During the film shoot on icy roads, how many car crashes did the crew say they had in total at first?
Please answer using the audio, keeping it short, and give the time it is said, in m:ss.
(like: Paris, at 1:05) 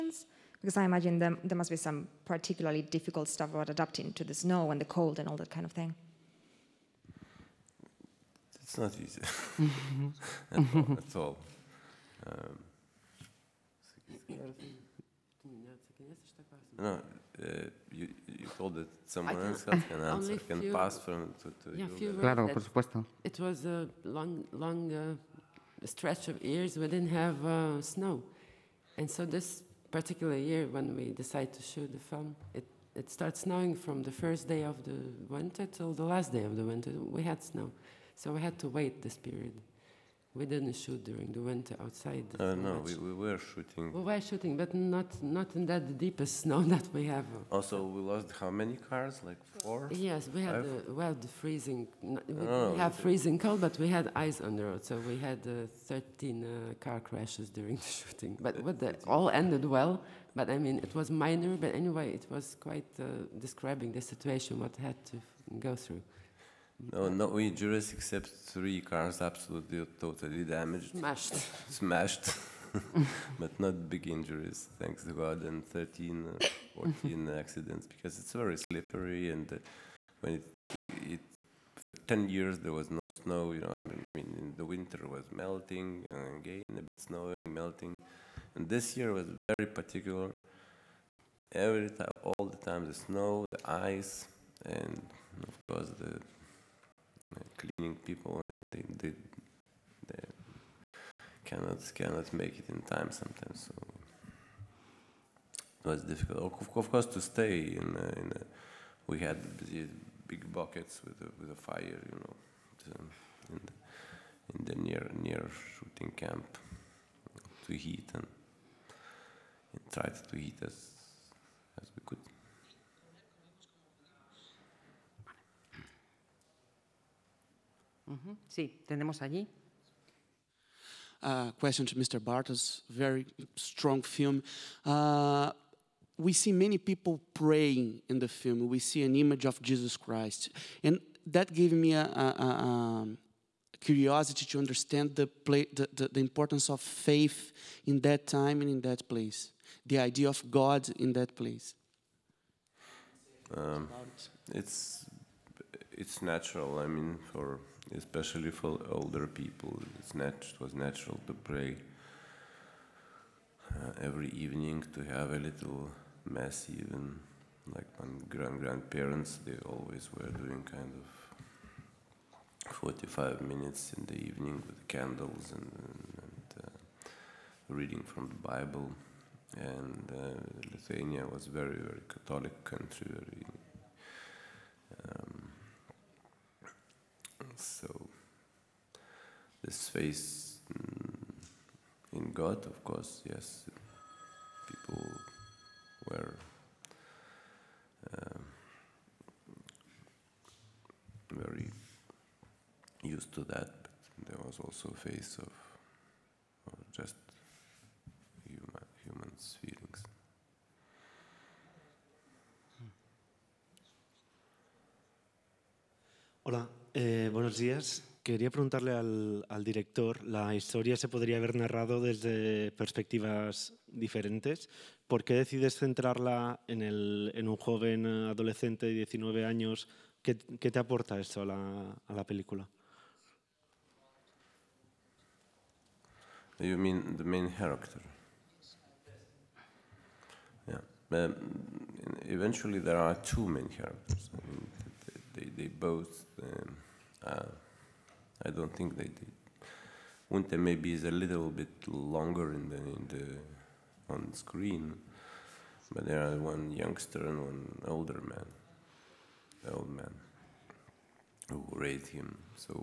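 13, at 0:55.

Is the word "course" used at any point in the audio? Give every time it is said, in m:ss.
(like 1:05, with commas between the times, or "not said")
1:35, 1:46, 3:12.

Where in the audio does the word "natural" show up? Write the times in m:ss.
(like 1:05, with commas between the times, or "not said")
2:36, 2:40.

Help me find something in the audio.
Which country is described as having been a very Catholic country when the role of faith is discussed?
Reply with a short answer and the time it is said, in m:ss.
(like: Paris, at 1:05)
Lithuania, at 3:00.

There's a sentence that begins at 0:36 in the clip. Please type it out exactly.
We had snow, so we had to wait this period.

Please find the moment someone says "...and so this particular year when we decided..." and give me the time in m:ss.
0:28.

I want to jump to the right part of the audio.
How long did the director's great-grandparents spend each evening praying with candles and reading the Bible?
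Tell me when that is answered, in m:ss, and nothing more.
2:52.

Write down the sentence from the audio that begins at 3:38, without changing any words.
Quería preguntarle al, director, la historia se podría haber narrado desde perspectivas diferentes.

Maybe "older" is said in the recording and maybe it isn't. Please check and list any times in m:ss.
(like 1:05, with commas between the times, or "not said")
2:38, 4:17.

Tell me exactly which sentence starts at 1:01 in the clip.
But anyway, it was quite uh, describing the situation what had to go through.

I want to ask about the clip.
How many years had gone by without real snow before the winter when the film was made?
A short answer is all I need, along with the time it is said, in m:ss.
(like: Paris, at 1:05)
10, at 1:21.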